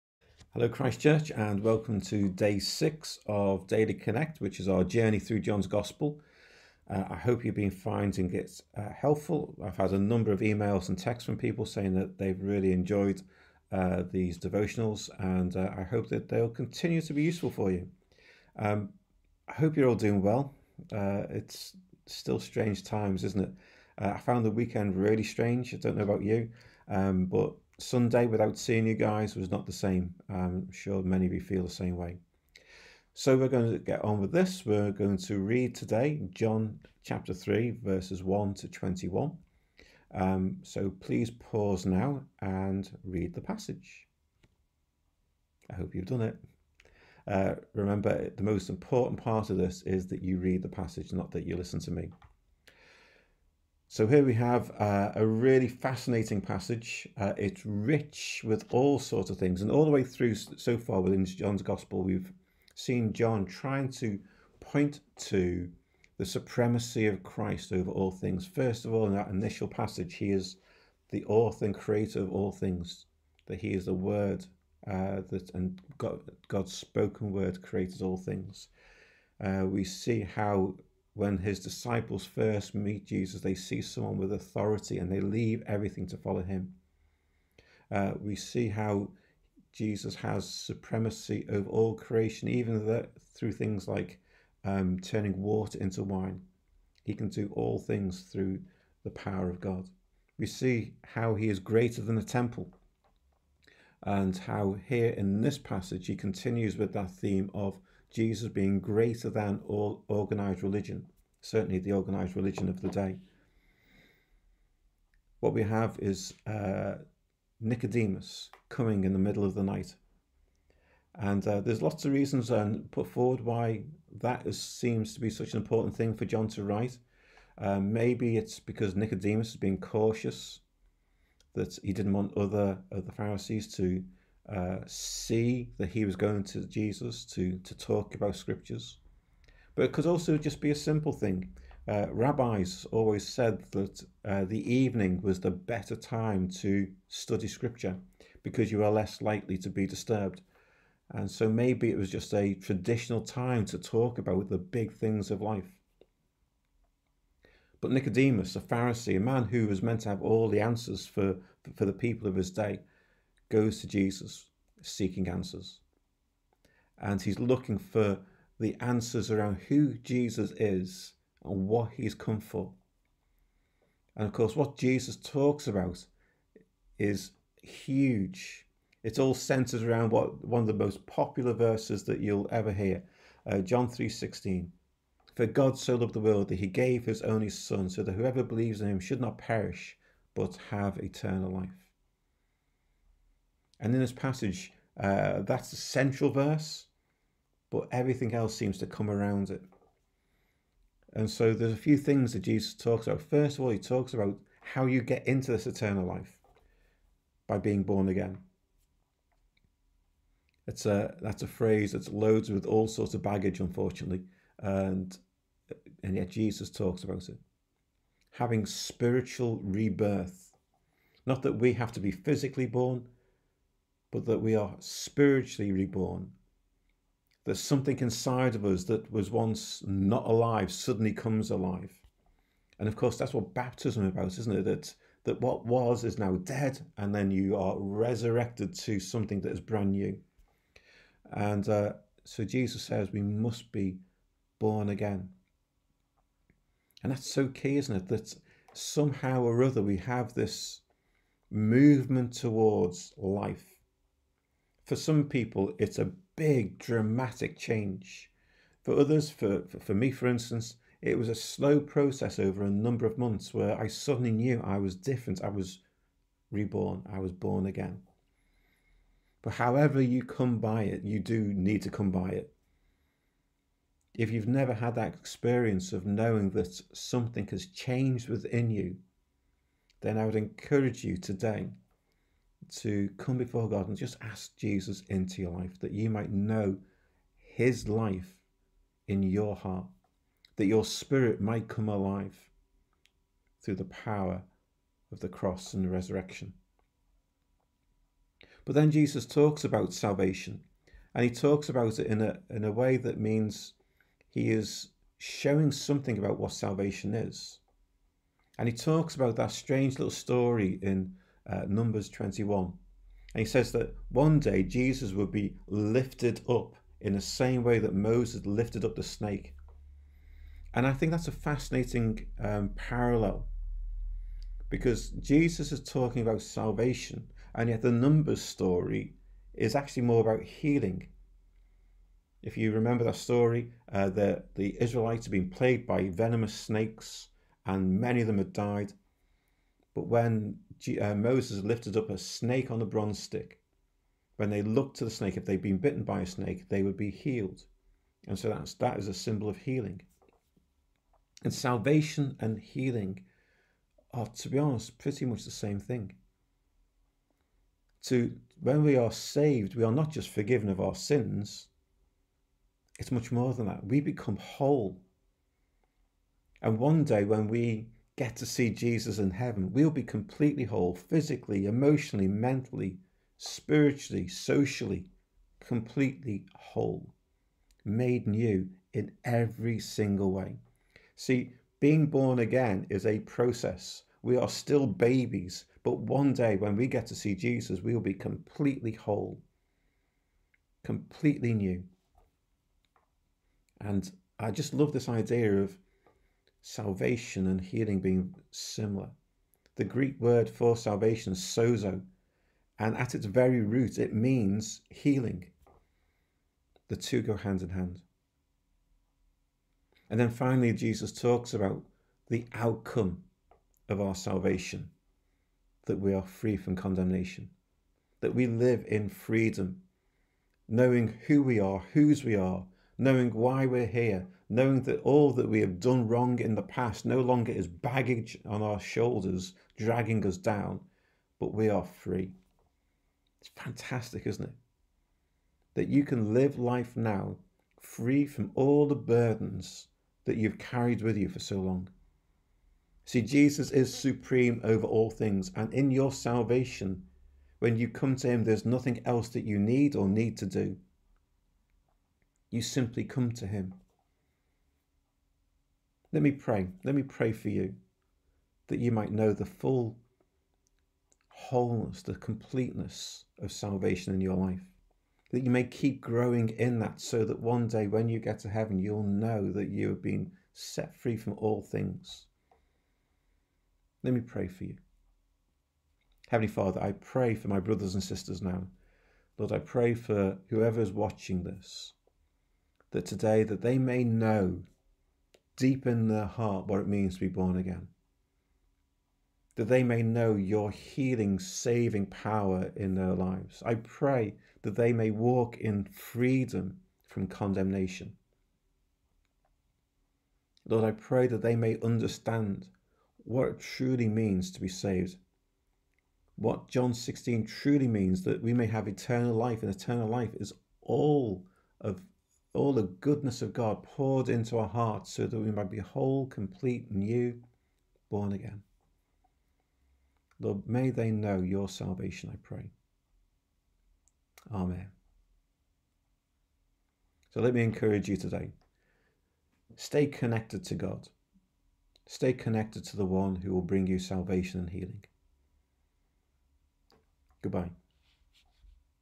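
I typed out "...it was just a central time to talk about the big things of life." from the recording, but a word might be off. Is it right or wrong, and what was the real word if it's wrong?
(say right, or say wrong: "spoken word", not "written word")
wrong: "traditional", not "central".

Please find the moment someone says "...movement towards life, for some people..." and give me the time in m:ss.
4:11.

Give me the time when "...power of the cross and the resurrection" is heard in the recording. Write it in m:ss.
4:53.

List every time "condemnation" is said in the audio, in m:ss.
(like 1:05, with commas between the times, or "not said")
6:56, 8:17.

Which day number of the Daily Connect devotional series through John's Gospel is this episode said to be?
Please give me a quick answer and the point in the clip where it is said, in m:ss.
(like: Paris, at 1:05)
6, at 0:02.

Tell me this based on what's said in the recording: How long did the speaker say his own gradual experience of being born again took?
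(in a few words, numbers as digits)
A number of months.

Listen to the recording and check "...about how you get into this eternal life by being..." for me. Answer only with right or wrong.
right.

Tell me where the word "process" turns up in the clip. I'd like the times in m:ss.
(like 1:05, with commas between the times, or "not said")
4:21, 6:23.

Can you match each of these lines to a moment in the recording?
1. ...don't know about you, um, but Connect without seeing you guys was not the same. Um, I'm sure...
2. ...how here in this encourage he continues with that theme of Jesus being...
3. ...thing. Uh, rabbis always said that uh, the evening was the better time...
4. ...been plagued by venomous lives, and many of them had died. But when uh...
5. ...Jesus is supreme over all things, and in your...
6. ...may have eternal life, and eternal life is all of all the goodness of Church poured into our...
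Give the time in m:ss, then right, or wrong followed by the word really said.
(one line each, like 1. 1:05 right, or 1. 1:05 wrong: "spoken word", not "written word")
1. 0:25 wrong: "Sunday", not "Connect"
2. 1:44 wrong: "passage", not "encourage"
3. 2:21 right
4. 5:35 wrong: "snakes", not "lives"
5. 7:23 right
6. 8:28 wrong: "God", not "Church".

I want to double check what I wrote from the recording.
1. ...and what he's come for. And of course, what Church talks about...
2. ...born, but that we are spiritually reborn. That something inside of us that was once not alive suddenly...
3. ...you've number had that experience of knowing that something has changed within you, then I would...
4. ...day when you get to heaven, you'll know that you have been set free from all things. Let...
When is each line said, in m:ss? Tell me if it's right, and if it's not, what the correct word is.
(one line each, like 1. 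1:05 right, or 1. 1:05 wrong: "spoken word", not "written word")
1. 2:51 wrong: "Jesus", not "Church"
2. 3:42 right
3. 4:34 wrong: "never", not "number"
4. 7:47 right.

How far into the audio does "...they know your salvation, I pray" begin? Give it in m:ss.
8:40.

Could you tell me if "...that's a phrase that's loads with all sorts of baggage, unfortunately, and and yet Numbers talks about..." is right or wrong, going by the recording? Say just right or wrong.
wrong.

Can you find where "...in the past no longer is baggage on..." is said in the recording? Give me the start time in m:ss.
7:06.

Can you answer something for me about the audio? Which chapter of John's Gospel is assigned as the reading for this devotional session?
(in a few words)
Chapter 3.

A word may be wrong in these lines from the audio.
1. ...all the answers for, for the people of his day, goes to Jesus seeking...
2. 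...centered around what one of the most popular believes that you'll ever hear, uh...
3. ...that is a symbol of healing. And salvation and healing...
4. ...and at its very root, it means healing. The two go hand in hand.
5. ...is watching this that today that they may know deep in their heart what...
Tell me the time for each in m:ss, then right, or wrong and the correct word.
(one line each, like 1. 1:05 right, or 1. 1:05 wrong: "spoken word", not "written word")
1. 2:40 right
2. 2:59 wrong: "verses", not "believes"
3. 5:48 right
4. 6:42 right
5. 8:00 right.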